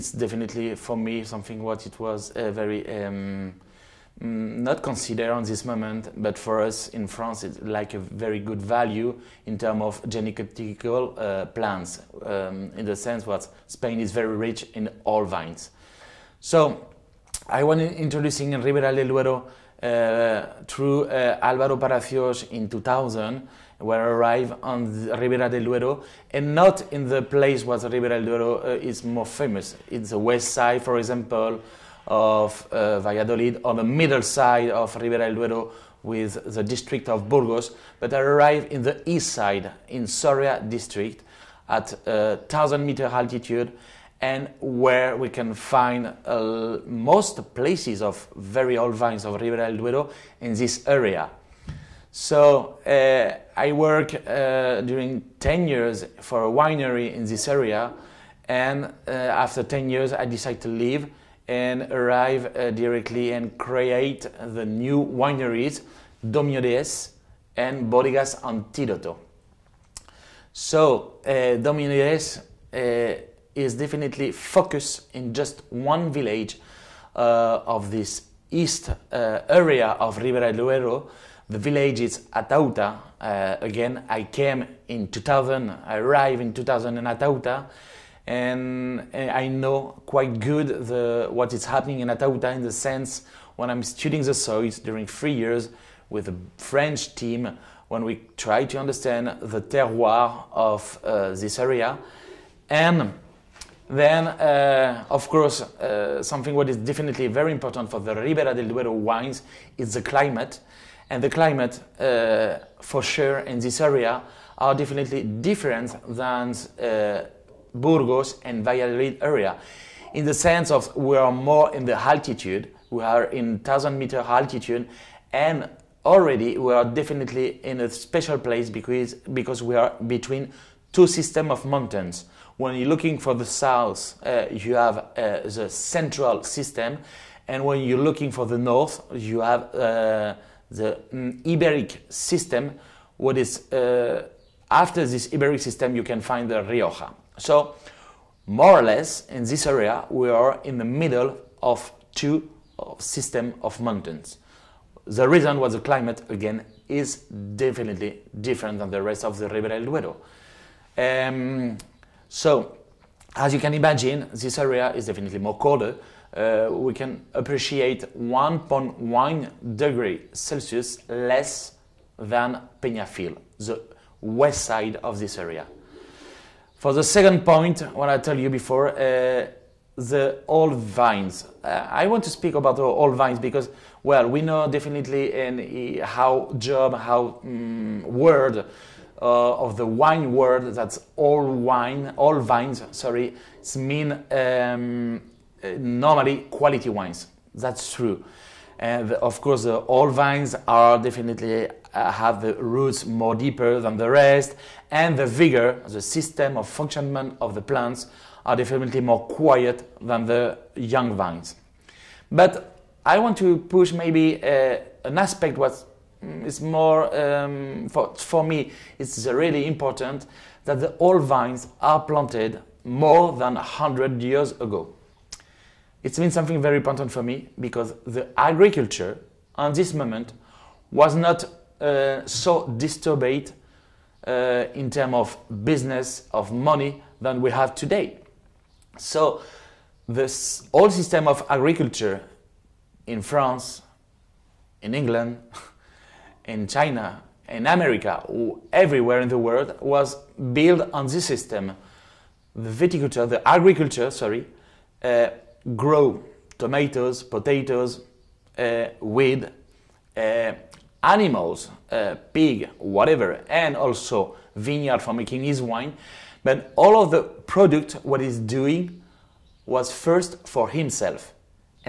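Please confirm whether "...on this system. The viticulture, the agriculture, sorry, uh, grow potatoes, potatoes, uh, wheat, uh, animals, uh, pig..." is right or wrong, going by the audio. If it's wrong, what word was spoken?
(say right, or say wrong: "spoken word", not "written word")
wrong: "tomatoes", not "potatoes".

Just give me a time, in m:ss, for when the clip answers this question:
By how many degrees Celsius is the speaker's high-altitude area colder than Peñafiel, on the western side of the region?
2:48.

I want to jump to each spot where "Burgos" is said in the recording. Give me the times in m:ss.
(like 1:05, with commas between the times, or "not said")
0:37, 1:57.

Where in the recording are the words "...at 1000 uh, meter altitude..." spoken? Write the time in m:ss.
0:41.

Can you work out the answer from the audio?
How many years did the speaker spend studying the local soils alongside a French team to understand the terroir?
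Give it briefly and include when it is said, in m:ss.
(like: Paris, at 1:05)
3, at 1:35.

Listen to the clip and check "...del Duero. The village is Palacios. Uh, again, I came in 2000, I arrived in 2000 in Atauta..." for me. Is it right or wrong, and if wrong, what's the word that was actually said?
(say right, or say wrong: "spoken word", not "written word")
wrong: "Atauta", not "Palacios".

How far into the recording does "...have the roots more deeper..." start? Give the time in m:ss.
3:22.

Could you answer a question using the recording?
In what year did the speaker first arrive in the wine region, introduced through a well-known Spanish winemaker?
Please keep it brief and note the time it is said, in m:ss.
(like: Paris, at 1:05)
2000, at 0:22.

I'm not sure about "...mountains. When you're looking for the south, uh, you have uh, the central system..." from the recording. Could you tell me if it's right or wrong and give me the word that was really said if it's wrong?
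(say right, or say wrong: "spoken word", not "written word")
right.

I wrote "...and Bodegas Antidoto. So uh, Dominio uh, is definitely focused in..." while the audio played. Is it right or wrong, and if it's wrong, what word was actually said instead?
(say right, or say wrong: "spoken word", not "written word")
right.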